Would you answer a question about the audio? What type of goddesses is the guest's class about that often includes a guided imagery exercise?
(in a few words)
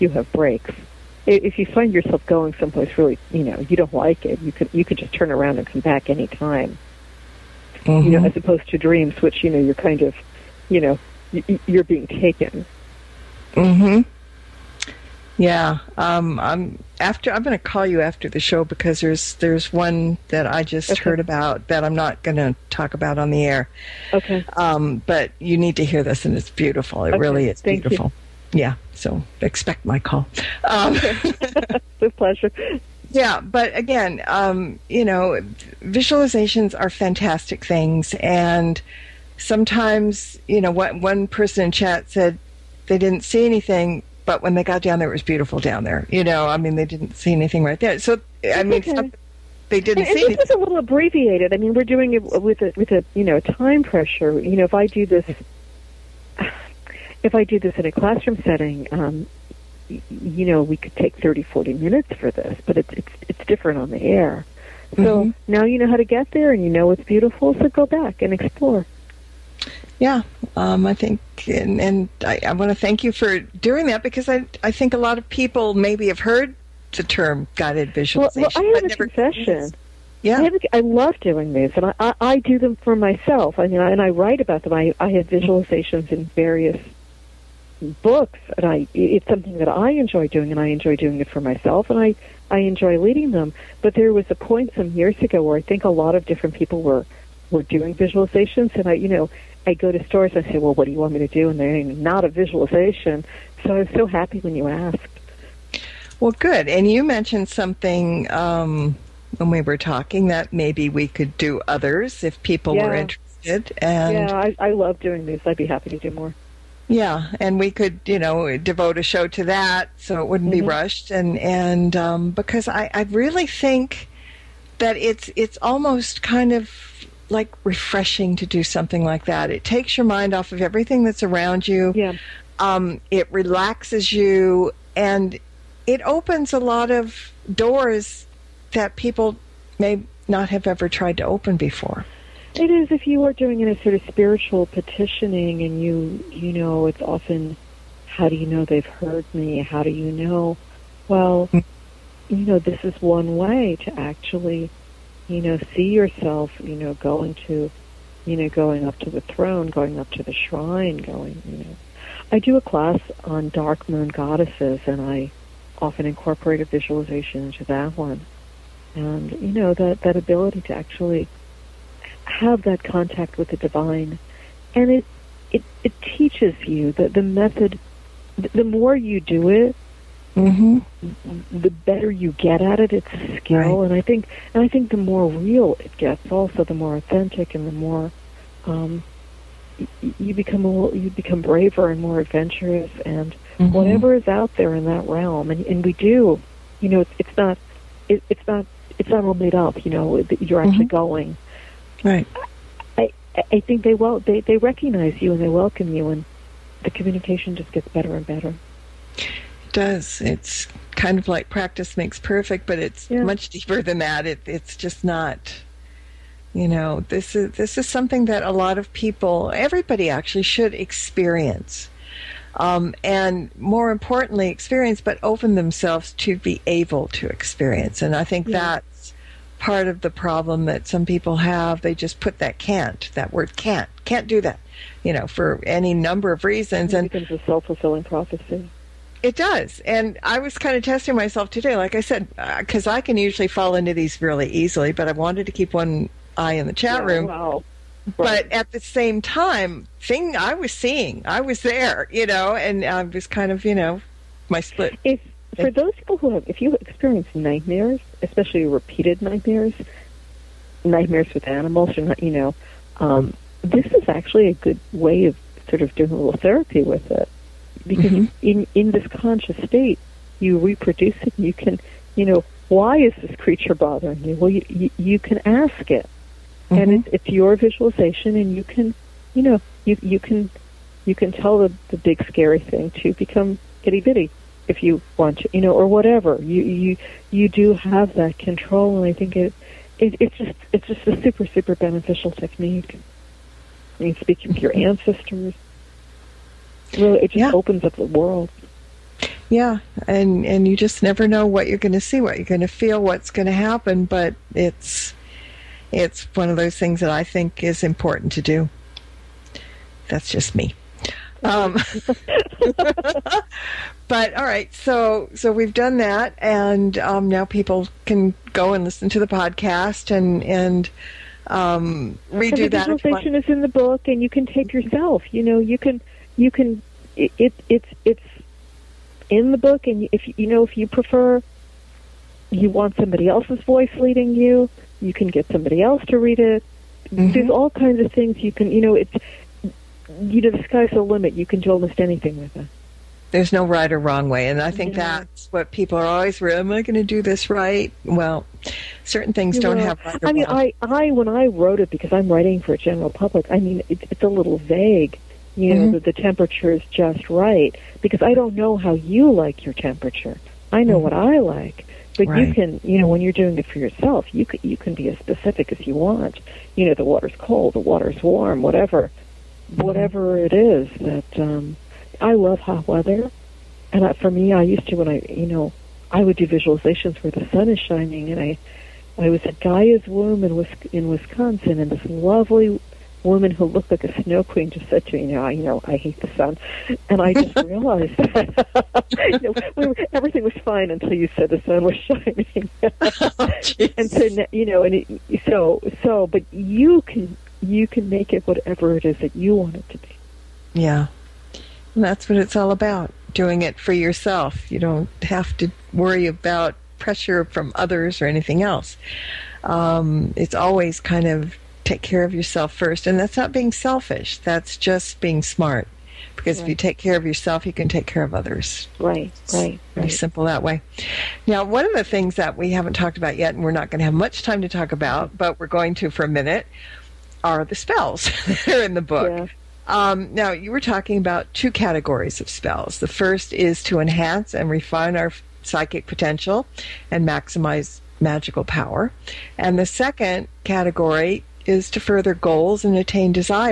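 Dark moon goddesses.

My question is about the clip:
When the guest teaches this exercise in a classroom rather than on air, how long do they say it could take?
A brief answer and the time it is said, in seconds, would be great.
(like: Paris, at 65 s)
30, 40 minutes, at 61 s.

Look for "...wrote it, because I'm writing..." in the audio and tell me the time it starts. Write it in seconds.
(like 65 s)
351 s.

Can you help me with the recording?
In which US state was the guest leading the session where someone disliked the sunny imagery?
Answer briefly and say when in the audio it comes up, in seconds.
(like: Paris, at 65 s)
Wisconsin, at 381 s.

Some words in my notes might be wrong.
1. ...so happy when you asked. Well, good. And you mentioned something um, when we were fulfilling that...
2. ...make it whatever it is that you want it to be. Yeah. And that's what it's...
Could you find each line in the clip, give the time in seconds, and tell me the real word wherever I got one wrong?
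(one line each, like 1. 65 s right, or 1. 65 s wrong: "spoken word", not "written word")
1. 103 s wrong: "talking", not "fulfilling"
2. 398 s right.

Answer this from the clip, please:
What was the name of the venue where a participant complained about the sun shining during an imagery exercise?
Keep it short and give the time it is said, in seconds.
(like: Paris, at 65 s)
Gaia's womb, at 379 s.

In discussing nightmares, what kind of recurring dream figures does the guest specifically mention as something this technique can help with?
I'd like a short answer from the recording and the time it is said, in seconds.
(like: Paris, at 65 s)
Animals, at 261 s.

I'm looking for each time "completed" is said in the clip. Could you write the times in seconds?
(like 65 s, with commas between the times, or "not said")
not said.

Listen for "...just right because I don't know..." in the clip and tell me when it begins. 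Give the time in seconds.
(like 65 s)
356 s.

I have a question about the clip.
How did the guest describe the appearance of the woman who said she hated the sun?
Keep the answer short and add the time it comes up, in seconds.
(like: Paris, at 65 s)
Like a snow queen, at 383 s.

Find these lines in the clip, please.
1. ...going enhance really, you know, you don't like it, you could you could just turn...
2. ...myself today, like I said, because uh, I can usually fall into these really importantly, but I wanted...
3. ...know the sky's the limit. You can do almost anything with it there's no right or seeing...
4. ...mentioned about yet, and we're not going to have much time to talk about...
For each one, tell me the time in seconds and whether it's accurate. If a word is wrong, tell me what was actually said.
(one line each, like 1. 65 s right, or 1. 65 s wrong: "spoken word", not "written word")
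1. 2 s wrong: "someplace", not "enhance"
2. 241 s wrong: "easily", not "importantly"
3. 340 s wrong: "wrong", not "seeing"
4. 422 s wrong: "talked", not "mentioned".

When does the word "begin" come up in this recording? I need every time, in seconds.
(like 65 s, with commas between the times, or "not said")
not said.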